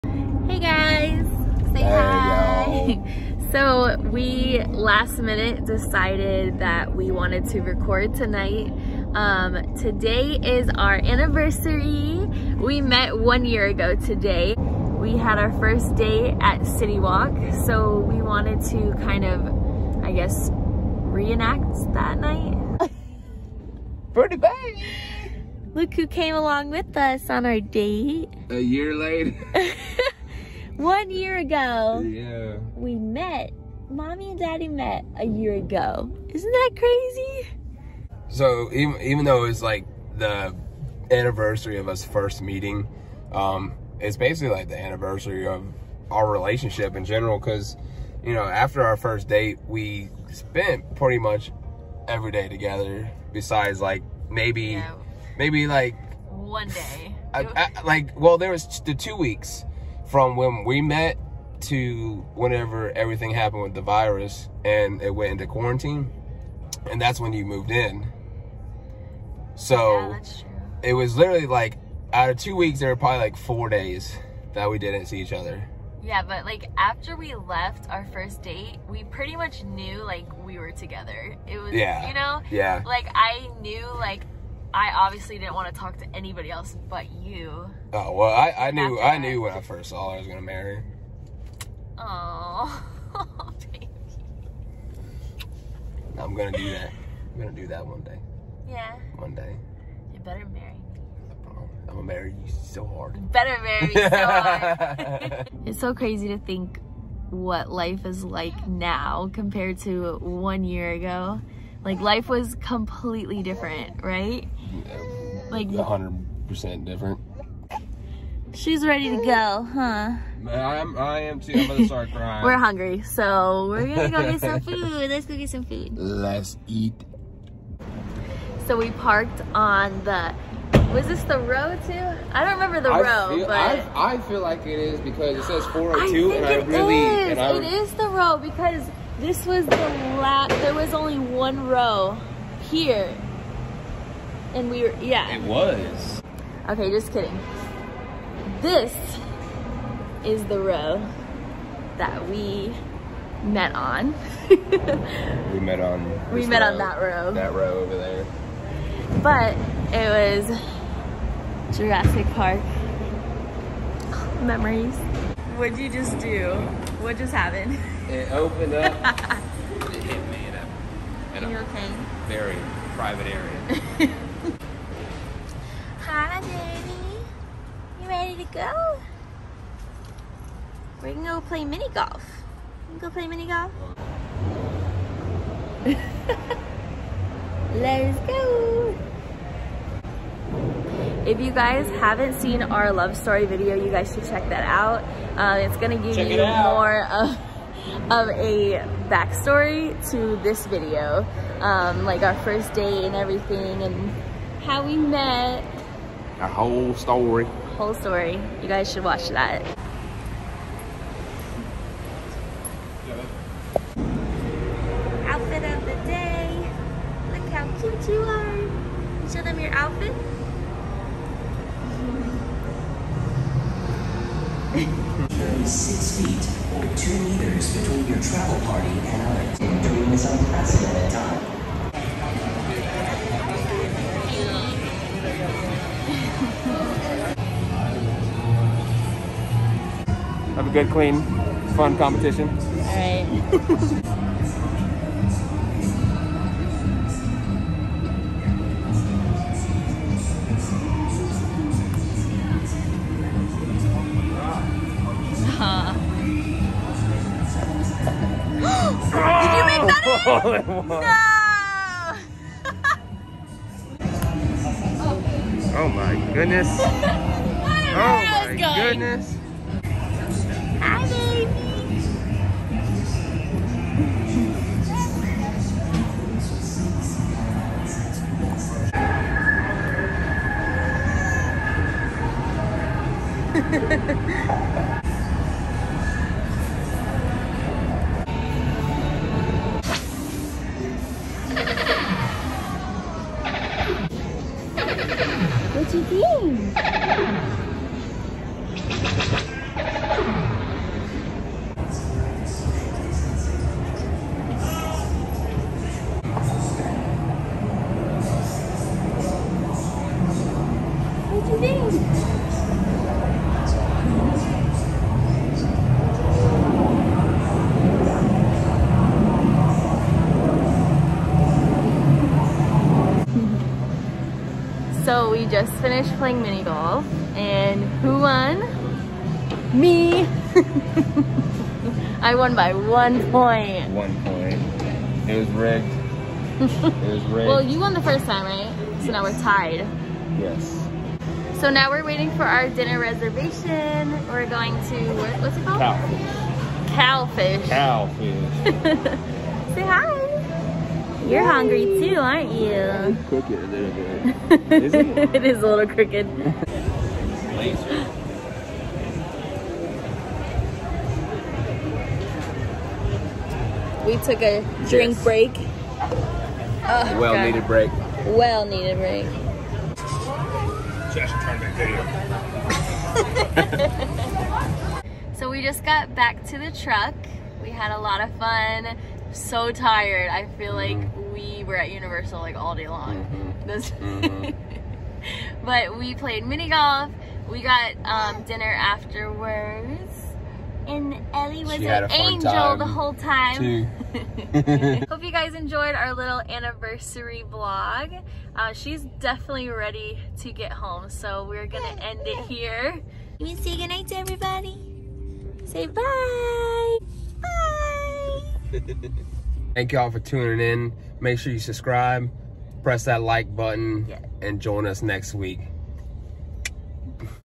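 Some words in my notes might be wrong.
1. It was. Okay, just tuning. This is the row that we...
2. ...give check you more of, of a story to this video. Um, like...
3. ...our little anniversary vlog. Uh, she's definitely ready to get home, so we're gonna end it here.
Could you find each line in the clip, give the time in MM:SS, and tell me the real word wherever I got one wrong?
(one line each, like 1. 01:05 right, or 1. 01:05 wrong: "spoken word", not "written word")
1. 02:25 wrong: "kidding", not "tuning"
2. 03:15 wrong: "backstory", not "story"
3. 06:35 right.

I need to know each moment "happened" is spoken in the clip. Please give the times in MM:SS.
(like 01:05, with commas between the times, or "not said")
01:03, 02:47.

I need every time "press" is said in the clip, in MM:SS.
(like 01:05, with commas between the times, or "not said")
06:52.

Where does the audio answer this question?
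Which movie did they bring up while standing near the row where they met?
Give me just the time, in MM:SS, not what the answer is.
02:41.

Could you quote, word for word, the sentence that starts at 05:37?
Well, you won the first time, right?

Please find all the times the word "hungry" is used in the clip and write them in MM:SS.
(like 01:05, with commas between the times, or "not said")
02:02, 05:51.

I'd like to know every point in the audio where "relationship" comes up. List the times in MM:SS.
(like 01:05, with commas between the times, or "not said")
00:46.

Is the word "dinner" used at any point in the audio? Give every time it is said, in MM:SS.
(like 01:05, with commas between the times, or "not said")
05:42, 06:28.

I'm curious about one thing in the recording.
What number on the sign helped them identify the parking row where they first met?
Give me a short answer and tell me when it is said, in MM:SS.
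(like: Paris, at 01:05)
402, at 02:15.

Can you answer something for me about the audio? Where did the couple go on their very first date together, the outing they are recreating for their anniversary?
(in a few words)
City Walk.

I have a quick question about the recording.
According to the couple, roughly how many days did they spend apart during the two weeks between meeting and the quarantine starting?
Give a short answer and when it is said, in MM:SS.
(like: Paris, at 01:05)
4, at 01:13.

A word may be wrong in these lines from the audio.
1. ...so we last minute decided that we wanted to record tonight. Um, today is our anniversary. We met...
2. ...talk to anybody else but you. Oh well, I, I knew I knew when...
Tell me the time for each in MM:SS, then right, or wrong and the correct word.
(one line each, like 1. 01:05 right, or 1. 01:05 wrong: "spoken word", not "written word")
1. 00:03 right
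2. 01:25 right.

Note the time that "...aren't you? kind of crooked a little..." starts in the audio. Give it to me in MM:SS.
05:52.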